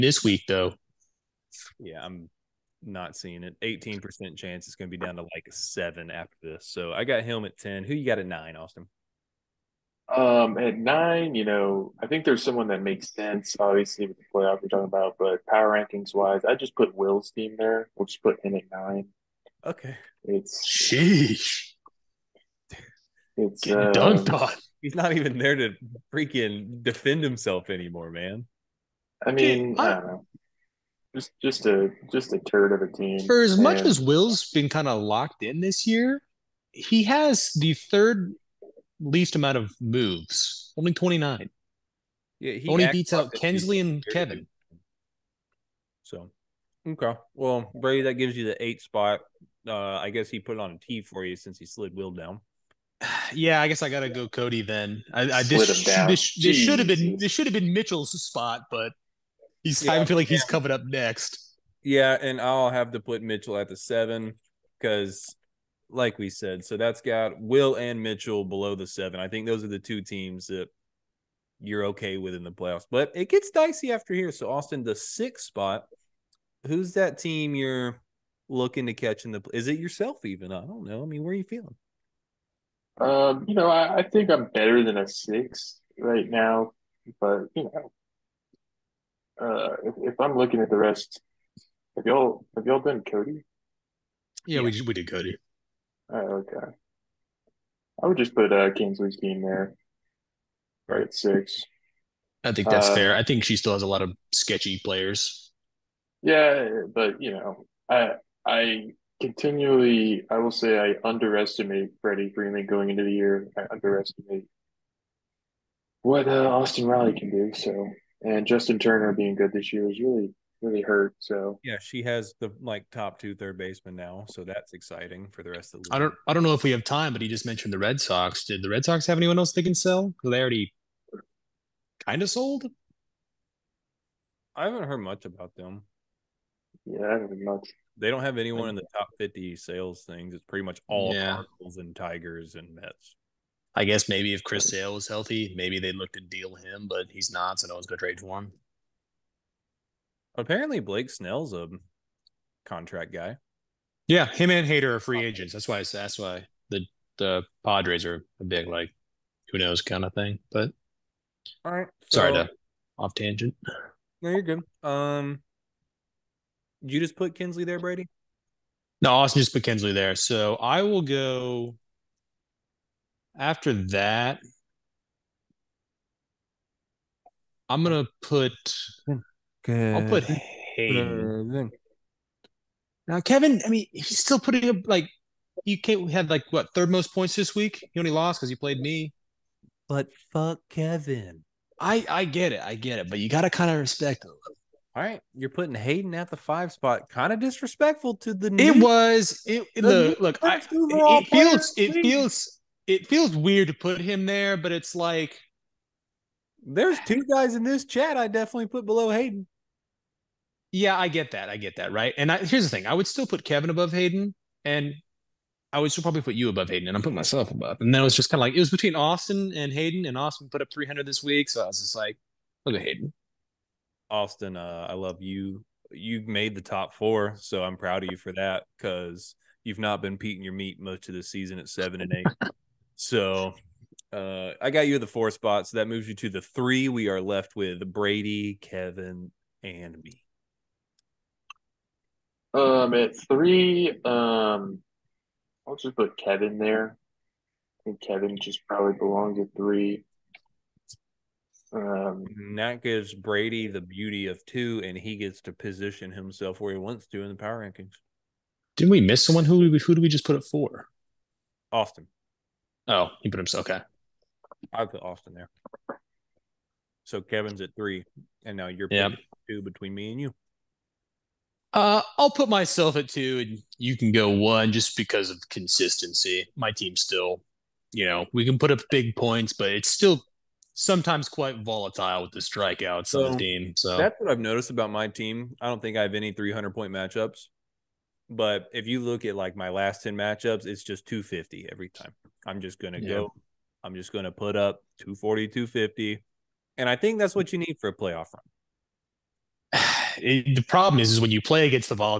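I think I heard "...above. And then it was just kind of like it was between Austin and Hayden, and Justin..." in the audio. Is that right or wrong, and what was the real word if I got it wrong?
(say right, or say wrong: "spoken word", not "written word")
wrong: "Austin", not "Justin".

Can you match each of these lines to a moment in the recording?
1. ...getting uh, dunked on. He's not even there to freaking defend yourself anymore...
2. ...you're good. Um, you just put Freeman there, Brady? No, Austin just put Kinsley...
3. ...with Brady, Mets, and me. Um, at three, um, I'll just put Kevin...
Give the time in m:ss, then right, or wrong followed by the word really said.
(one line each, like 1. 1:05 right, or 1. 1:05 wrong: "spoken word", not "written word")
1. 0:23 wrong: "himself", not "yourself"
2. 2:44 wrong: "Kinsley", not "Freeman"
3. 3:57 wrong: "Kevin", not "Mets".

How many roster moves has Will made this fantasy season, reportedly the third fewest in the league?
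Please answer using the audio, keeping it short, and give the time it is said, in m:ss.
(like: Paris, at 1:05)
29, at 0:40.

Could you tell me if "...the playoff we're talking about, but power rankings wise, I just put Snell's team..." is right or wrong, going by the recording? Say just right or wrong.
wrong.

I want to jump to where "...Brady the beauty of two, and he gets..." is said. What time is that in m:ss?
4:13.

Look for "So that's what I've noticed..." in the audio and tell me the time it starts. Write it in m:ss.
4:43.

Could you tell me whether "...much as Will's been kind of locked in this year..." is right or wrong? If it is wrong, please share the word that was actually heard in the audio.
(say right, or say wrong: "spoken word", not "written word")
right.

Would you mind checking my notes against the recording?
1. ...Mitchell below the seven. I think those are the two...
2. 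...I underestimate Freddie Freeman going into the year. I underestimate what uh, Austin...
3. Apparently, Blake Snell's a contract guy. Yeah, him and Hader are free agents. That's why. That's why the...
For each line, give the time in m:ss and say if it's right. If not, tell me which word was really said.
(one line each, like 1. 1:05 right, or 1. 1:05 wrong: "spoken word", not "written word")
1. 1:08 right
2. 1:50 right
3. 2:30 right.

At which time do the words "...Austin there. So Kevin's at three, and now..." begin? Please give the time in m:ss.
4:25.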